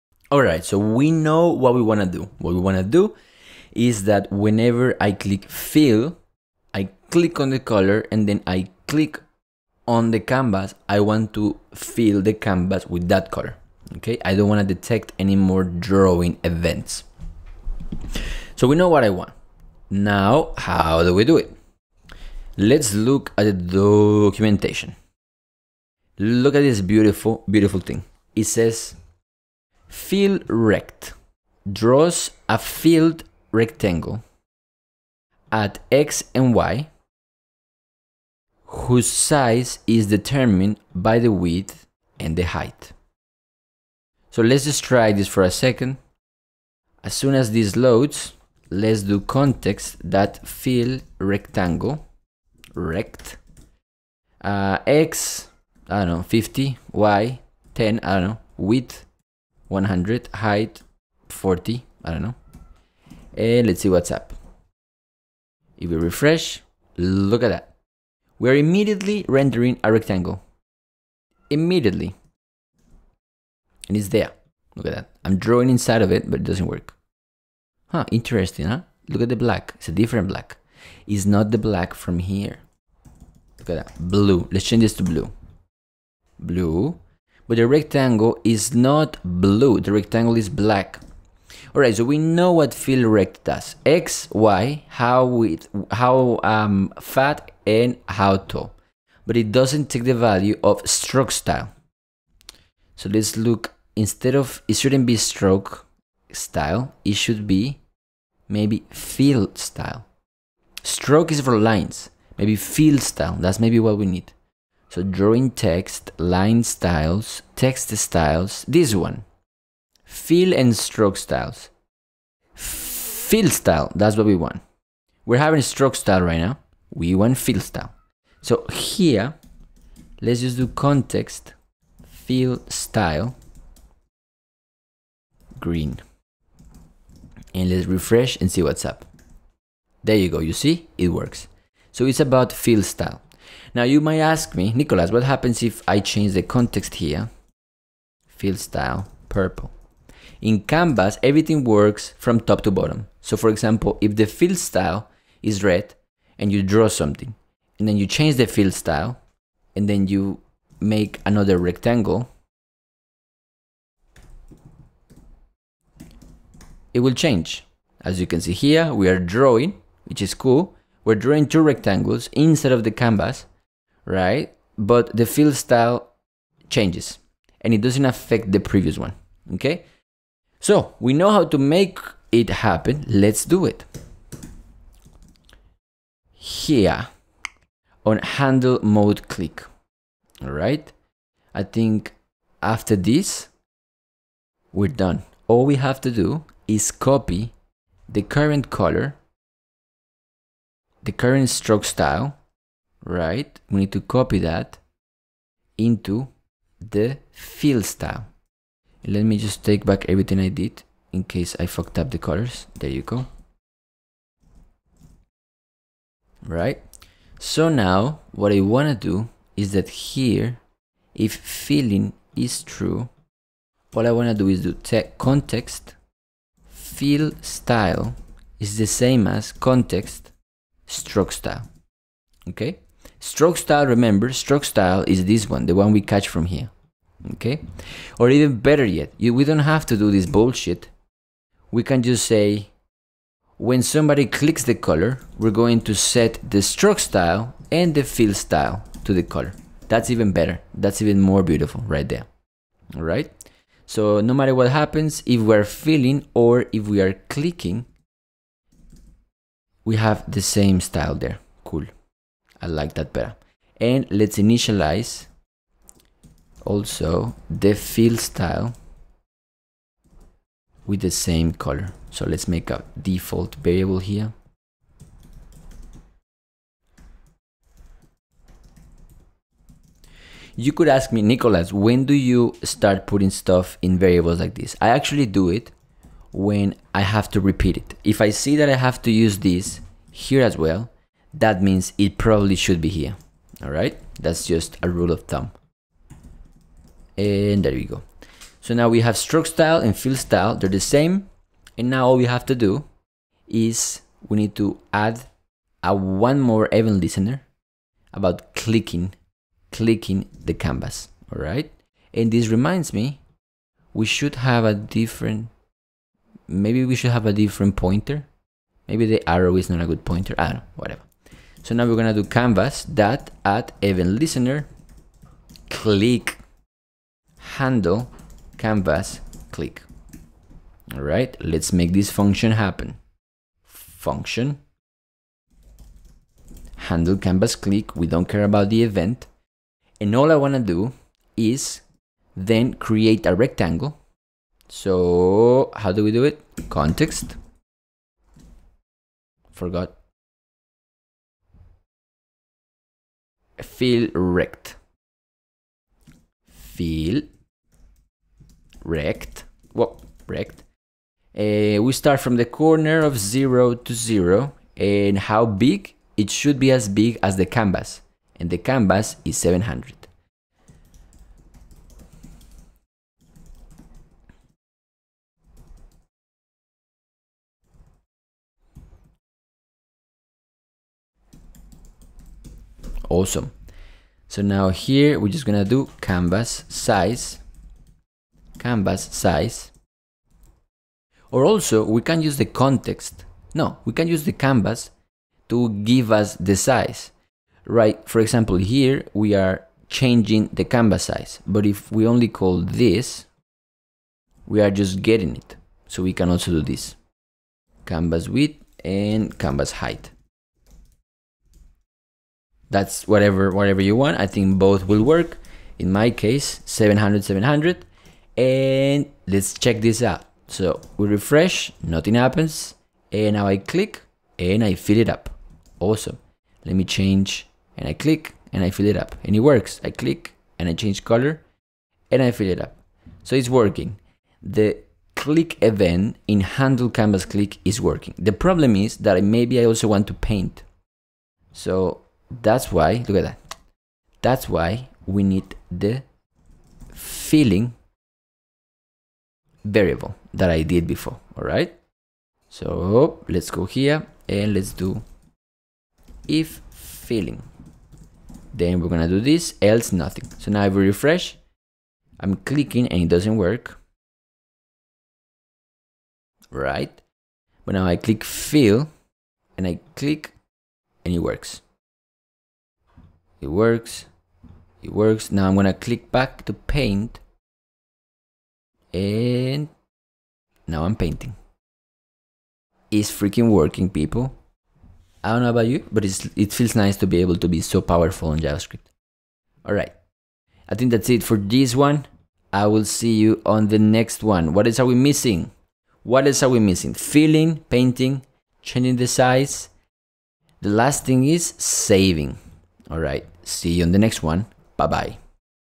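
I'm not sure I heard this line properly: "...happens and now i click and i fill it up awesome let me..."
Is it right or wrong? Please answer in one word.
right.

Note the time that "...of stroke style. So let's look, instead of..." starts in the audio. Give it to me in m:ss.
1:40.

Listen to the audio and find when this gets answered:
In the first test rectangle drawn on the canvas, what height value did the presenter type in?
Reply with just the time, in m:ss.
1:01.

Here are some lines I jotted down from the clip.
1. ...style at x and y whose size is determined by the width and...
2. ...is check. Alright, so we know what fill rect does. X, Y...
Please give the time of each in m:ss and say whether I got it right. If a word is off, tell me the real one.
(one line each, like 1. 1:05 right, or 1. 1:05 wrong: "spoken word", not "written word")
1. 0:33 wrong: "rectangle", not "style"
2. 1:30 wrong: "black", not "check".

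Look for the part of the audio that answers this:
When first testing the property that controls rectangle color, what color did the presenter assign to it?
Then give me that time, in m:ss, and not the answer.
2:15.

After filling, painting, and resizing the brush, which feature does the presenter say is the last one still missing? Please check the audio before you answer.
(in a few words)
Saving.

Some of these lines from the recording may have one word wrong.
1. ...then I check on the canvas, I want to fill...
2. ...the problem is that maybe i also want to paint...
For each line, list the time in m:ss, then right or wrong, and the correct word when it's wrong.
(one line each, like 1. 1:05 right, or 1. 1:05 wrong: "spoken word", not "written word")
1. 0:08 wrong: "click", not "check"
2. 7:18 right.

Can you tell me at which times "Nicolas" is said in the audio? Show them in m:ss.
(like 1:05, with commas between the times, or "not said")
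2:24, 4:41.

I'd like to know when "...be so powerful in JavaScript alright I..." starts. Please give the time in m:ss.
8:07.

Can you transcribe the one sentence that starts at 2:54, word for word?
But the fill style changes and it doesn't affect the previous one, okay?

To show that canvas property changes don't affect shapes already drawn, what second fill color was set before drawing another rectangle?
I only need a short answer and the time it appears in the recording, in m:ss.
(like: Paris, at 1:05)
Purple, at 2:29.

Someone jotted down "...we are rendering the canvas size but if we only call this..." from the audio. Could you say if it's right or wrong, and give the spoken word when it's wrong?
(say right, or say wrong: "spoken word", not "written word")
wrong: "changing", not "rendering".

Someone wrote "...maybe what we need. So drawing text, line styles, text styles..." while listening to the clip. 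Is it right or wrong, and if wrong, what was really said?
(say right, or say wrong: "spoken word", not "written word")
right.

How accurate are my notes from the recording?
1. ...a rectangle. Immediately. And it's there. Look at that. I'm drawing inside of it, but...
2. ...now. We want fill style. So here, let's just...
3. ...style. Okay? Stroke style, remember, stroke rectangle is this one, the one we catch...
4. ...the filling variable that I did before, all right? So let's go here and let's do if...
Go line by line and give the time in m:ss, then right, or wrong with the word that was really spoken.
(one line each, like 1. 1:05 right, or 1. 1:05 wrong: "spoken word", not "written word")
1. 1:09 right
2. 2:06 right
3. 3:51 wrong: "style", not "rectangle"
4. 7:25 right.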